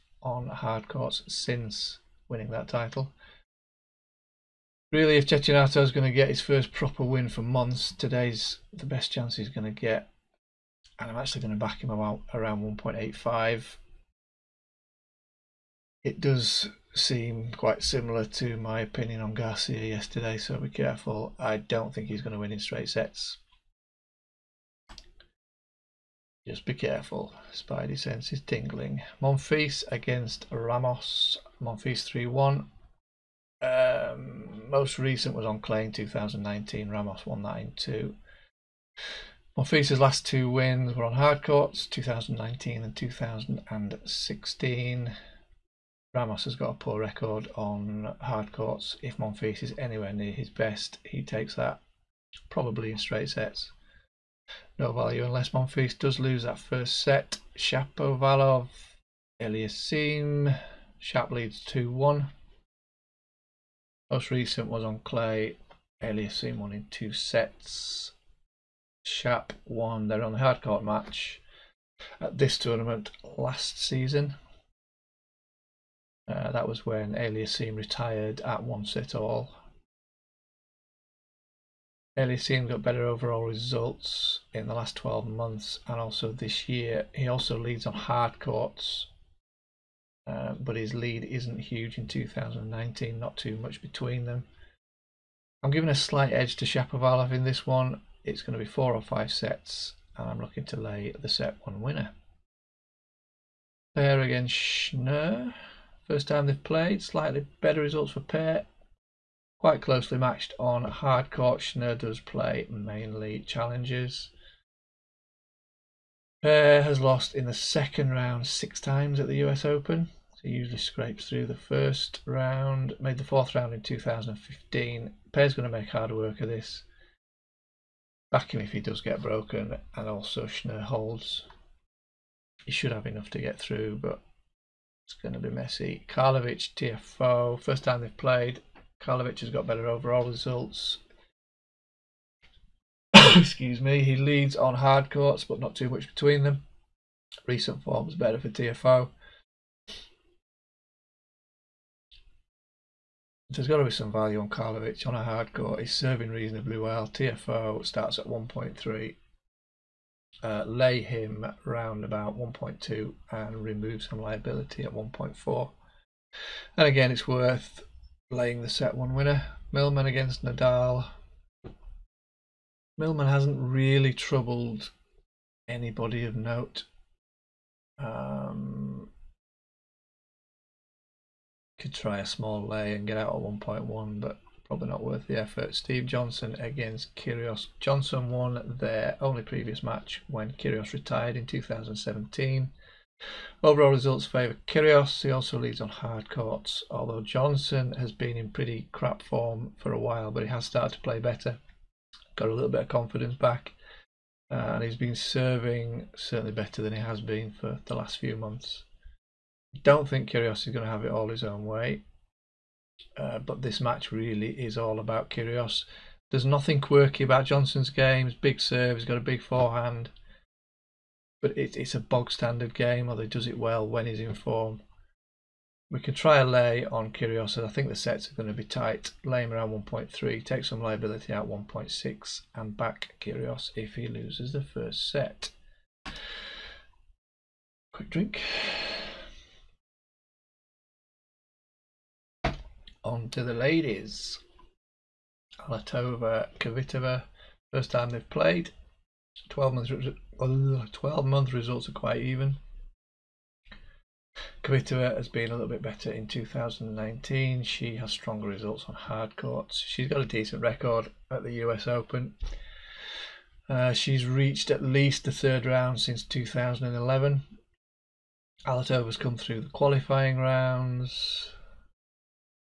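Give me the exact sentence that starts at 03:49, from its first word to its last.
Lay him around 1.3, take some liability out 1.6, and back Kyrgios if he loses the first set.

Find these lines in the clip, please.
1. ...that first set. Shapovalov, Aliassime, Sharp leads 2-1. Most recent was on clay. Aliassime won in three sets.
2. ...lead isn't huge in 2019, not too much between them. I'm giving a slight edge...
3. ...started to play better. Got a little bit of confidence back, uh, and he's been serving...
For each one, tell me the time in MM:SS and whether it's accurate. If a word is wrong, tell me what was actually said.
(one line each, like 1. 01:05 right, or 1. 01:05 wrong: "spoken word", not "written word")
1. 00:56 wrong: "two", not "three"
2. 01:30 right
3. 03:20 right.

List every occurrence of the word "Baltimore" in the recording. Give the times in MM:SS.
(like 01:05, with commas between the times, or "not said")
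not said.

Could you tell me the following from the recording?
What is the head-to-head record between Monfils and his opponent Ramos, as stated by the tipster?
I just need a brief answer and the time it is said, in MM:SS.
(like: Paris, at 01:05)
3-1, at 00:32.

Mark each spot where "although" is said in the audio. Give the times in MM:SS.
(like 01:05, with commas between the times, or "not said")
03:16, 03:43.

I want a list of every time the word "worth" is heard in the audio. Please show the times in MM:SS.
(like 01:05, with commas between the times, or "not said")
02:47, 03:05.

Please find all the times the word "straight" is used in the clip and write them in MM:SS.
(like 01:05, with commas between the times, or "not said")
00:22, 00:52.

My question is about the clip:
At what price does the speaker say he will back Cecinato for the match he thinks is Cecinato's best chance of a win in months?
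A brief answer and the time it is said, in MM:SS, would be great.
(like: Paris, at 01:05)
1.85, at 00:12.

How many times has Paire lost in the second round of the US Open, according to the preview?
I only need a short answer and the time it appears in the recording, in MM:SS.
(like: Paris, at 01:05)
6, at 01:58.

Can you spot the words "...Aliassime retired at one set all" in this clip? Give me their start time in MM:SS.
01:17.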